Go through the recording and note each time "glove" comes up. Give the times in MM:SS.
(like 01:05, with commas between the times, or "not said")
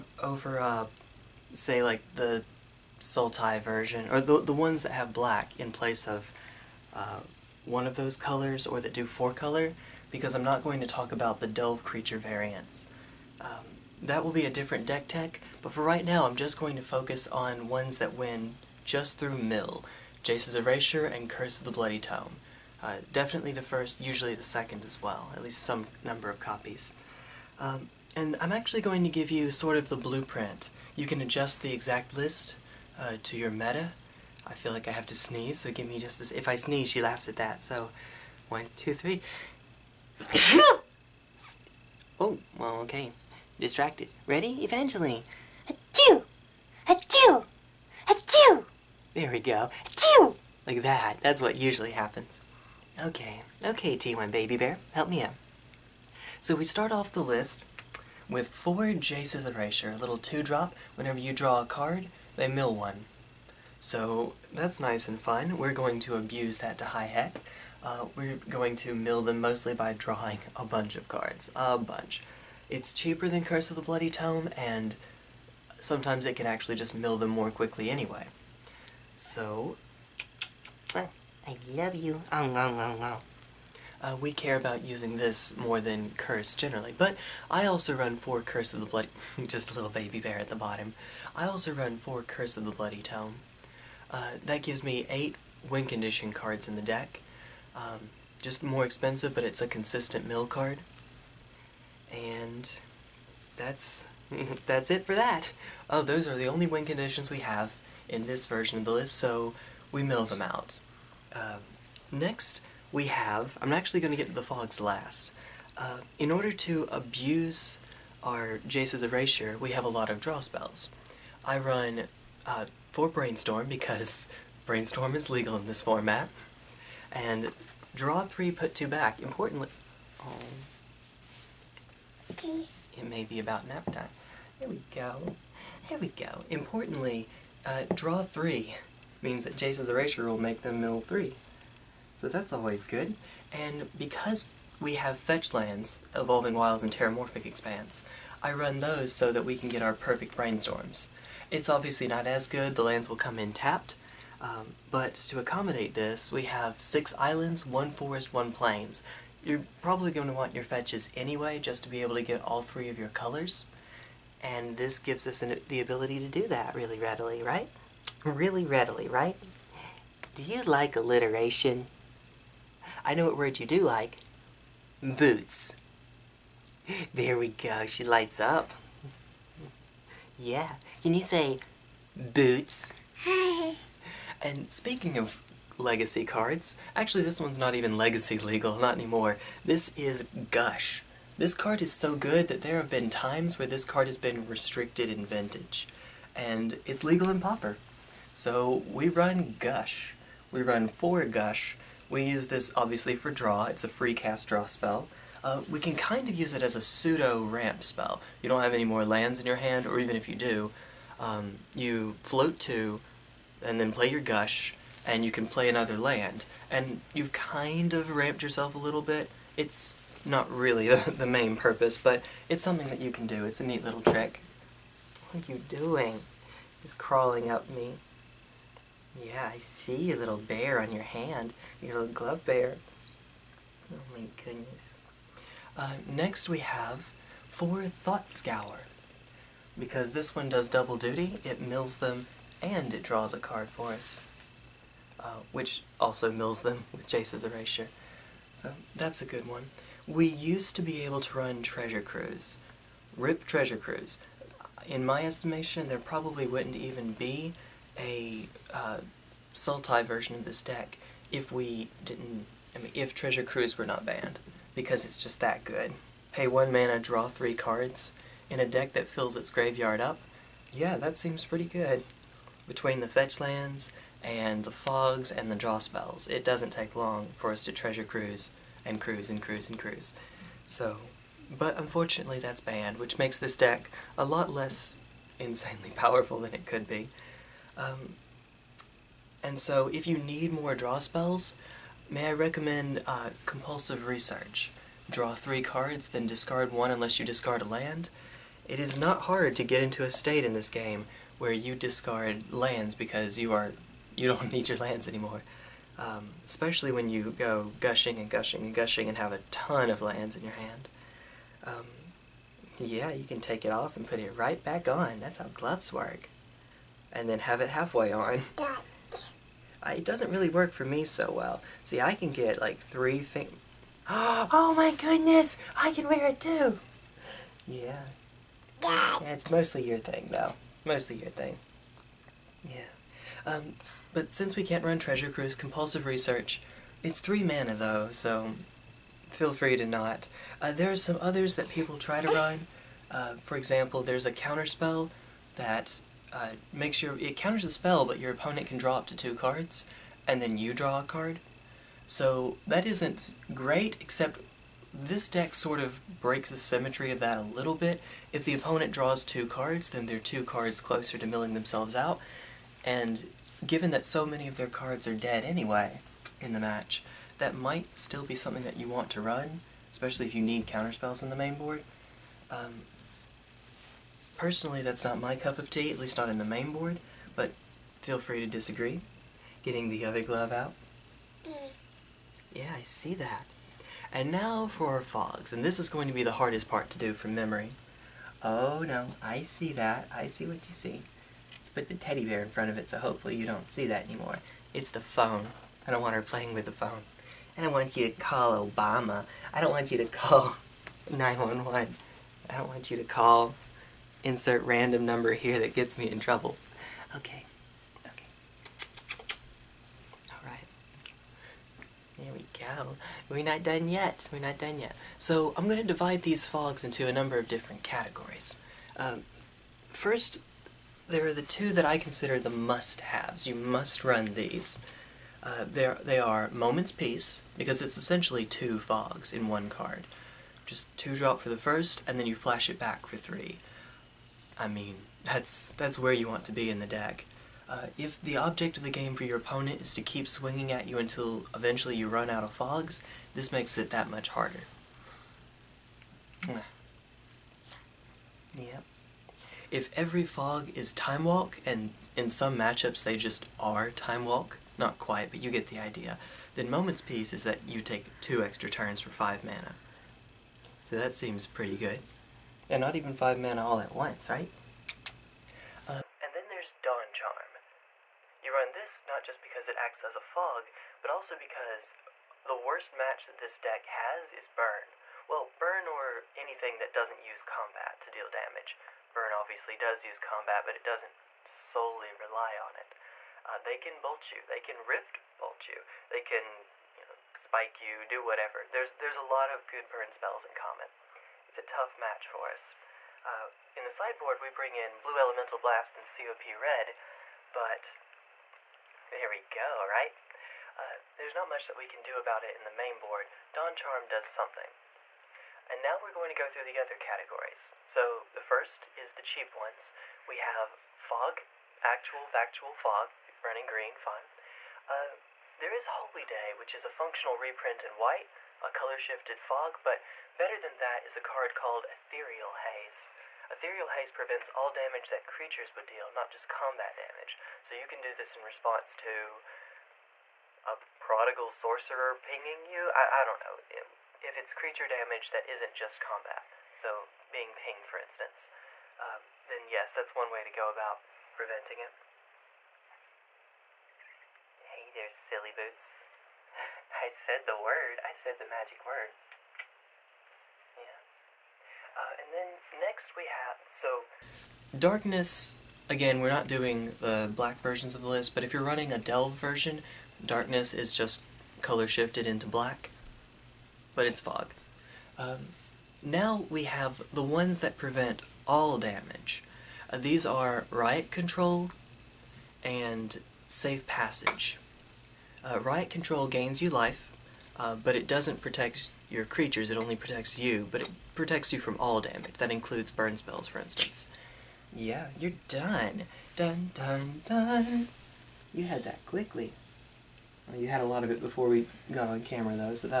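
03:52, 05:15, 06:20.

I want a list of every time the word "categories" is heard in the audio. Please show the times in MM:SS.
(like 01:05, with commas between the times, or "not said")
06:57, 08:26.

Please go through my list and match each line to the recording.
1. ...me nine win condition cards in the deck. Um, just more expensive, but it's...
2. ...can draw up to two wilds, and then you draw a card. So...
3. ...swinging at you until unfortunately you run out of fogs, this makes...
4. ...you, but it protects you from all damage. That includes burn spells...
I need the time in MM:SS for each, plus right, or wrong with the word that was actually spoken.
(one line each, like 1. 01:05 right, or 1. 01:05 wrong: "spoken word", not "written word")
1. 01:34 wrong: "eight", not "nine"
2. 05:48 wrong: "cards", not "wilds"
3. 07:20 wrong: "eventually", not "unfortunately"
4. 09:40 right.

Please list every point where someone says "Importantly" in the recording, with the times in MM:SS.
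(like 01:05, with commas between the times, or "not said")
02:09, 02:16.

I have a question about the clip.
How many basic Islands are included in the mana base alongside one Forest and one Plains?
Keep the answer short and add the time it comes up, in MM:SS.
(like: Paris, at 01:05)
6, at 02:36.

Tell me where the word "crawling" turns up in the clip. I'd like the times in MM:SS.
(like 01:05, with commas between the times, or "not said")
03:46.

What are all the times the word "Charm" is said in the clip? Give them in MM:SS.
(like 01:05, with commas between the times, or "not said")
07:47, 08:23.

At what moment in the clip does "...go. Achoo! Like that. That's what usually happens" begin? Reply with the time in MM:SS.
00:49.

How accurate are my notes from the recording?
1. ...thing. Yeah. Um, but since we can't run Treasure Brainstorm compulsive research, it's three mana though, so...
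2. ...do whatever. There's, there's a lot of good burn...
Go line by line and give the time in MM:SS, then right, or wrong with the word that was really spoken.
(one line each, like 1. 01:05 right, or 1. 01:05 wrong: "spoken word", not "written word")
1. 05:31 wrong: "Cruise", not "Brainstorm"
2. 08:08 right.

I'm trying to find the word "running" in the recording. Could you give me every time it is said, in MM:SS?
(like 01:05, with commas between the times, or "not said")
08:33, 09:18.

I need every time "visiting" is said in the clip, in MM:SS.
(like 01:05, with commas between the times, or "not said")
not said.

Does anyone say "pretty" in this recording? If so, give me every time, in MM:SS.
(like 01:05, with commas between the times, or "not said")
04:31, 07:41.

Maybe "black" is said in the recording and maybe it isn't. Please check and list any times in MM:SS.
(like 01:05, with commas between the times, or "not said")
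00:05, 09:17, 09:22.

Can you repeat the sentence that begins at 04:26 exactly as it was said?
Hey, one mana, draw three cards, in a deck that fills its graveyard up?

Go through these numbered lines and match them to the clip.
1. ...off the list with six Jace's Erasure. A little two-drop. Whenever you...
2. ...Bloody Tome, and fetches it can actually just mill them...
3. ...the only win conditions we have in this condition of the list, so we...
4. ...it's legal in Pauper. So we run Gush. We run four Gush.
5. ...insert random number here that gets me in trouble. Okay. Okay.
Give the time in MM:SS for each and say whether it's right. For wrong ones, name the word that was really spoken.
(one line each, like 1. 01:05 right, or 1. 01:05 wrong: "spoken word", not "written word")
1. 00:56 wrong: "four", not "six"
2. 01:13 wrong: "sometimes", not "fetches"
3. 01:46 wrong: "version", not "condition"
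4. 03:16 right
5. 06:44 right.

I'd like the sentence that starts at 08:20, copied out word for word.
Uh, there's not much that we can do about it in the main board.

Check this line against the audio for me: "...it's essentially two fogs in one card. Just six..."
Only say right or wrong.
wrong.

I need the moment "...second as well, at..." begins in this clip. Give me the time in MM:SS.
00:24.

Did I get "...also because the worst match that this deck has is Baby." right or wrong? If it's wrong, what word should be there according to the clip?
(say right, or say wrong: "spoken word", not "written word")
wrong: "Burn", not "Baby".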